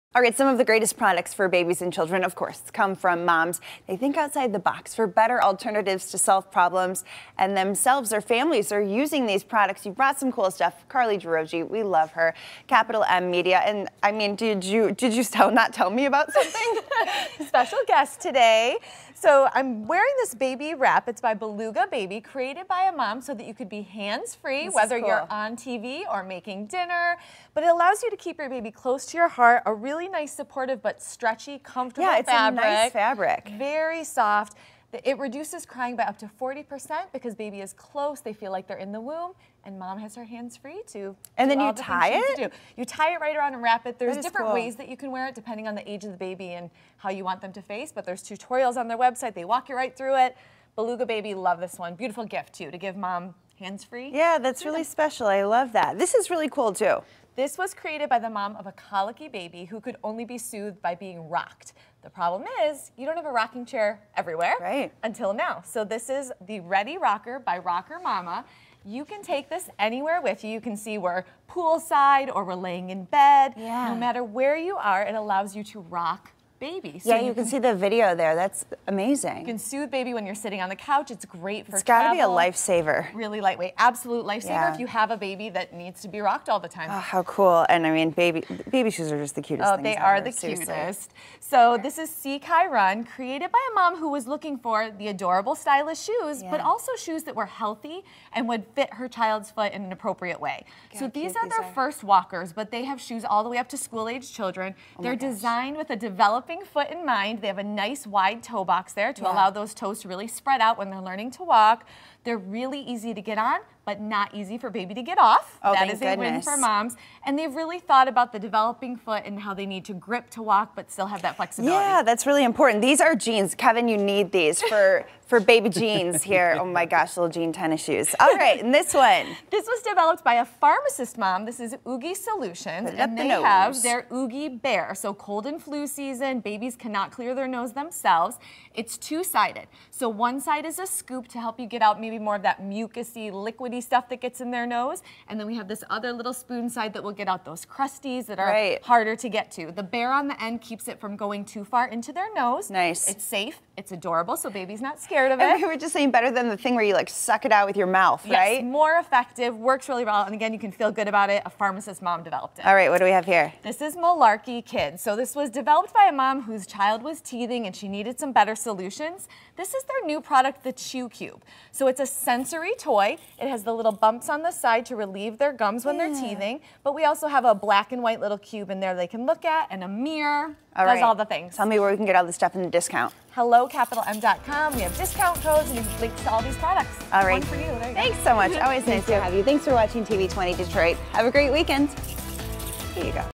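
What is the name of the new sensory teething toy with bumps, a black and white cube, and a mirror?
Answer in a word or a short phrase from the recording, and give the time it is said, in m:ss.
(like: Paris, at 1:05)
Chew Cube, at 2:50.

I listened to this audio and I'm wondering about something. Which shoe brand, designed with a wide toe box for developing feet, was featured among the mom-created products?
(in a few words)
See Kai Run.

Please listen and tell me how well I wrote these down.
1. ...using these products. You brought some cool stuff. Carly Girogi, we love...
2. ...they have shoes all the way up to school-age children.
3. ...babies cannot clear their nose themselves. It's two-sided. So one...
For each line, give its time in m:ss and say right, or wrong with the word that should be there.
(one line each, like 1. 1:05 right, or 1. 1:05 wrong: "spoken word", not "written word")
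1. 0:08 right
2. 1:42 right
3. 2:16 right.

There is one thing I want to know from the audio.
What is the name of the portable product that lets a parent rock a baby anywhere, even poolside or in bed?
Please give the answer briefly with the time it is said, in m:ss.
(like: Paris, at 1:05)
Ready Rocker, at 1:06.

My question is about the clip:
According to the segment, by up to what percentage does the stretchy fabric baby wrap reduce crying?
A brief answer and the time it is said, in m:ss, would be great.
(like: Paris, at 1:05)
40%, at 0:36.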